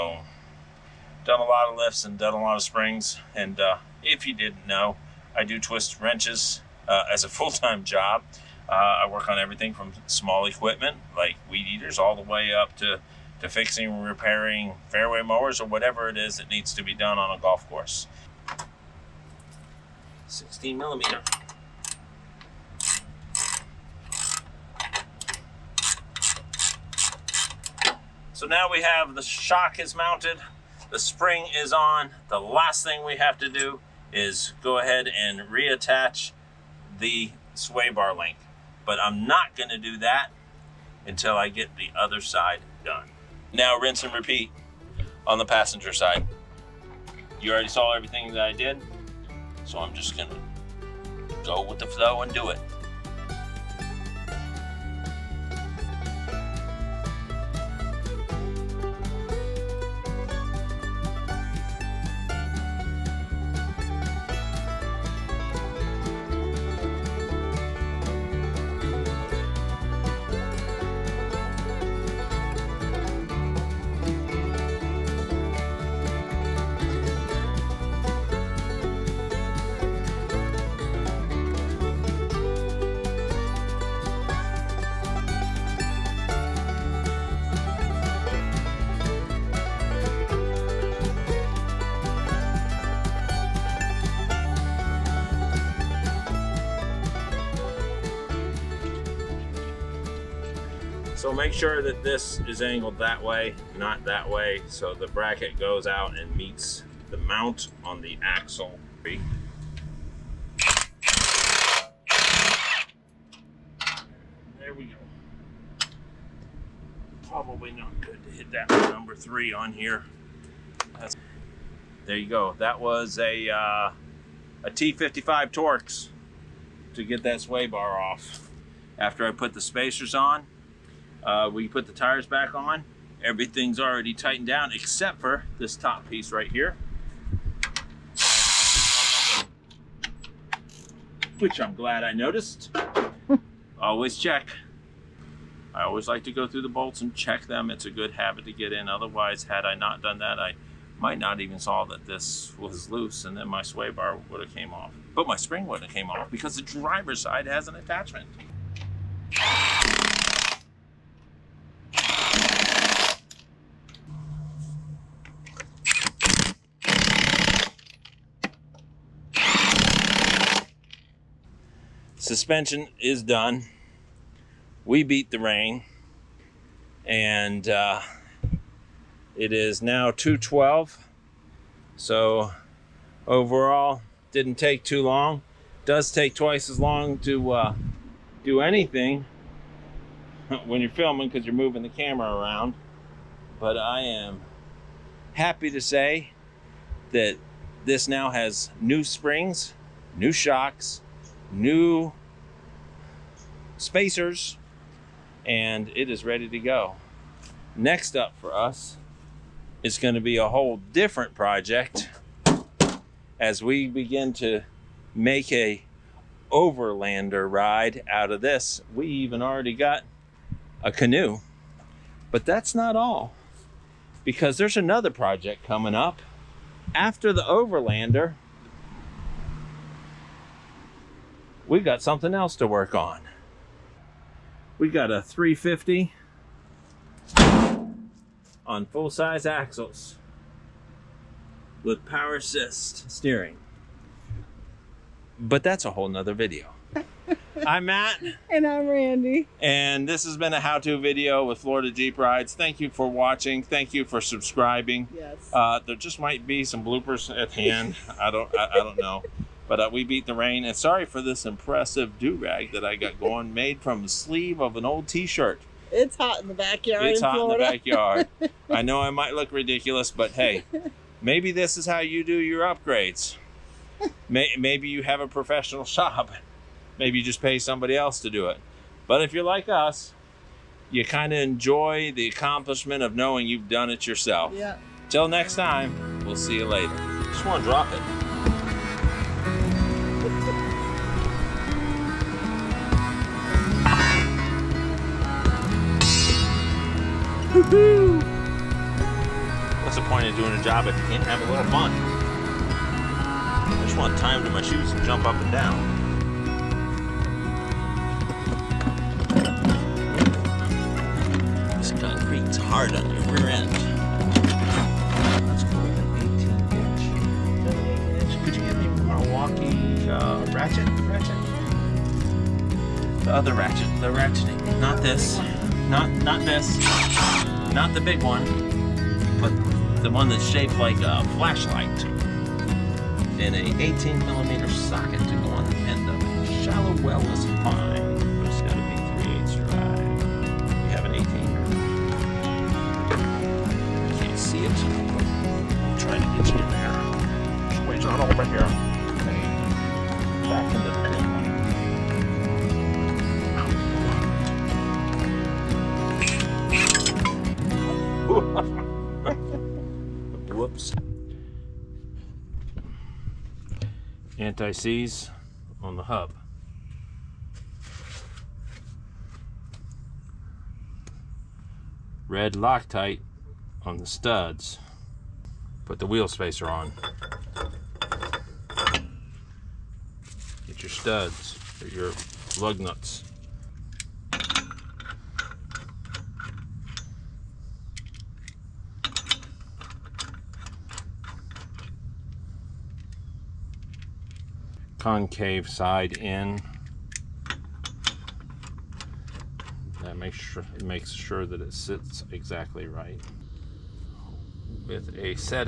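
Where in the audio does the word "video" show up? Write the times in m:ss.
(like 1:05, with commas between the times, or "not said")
4:06, 4:10.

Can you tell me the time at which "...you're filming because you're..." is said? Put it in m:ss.
3:10.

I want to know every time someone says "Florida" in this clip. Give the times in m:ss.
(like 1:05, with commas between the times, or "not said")
4:11, 4:27.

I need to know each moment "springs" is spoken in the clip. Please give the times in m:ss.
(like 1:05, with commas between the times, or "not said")
0:02, 0:30, 2:35, 3:19.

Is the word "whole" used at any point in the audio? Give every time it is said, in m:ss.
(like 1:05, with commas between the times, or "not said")
3:30, 4:05.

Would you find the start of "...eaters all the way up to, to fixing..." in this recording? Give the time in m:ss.
0:11.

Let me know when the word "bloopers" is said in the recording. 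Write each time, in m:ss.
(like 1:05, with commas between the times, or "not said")
4:16.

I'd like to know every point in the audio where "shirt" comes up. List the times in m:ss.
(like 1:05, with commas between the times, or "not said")
4:25.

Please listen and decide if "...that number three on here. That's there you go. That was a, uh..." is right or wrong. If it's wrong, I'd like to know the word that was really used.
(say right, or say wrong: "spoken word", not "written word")
right.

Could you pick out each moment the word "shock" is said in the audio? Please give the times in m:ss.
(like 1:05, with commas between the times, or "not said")
0:29, 3:20.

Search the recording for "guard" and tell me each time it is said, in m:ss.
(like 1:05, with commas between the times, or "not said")
not said.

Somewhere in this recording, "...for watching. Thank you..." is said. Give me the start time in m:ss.
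4:12.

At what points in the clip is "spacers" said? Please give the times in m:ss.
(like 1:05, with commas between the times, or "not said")
2:09, 3:23, 6:16.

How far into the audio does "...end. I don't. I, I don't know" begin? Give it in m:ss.
4:17.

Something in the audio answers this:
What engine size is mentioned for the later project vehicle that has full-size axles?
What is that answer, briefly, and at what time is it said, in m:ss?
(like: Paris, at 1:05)
350, at 3:55.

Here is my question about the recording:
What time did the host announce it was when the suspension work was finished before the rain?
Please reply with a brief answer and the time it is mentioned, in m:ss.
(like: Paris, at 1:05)
2:12, at 3:00.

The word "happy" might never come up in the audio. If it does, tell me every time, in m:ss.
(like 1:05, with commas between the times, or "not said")
3:15.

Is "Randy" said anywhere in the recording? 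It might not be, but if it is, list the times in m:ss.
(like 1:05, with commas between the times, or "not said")
4:08.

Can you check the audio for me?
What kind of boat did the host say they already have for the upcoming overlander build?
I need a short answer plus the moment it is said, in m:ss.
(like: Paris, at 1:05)
Canoe, at 3:40.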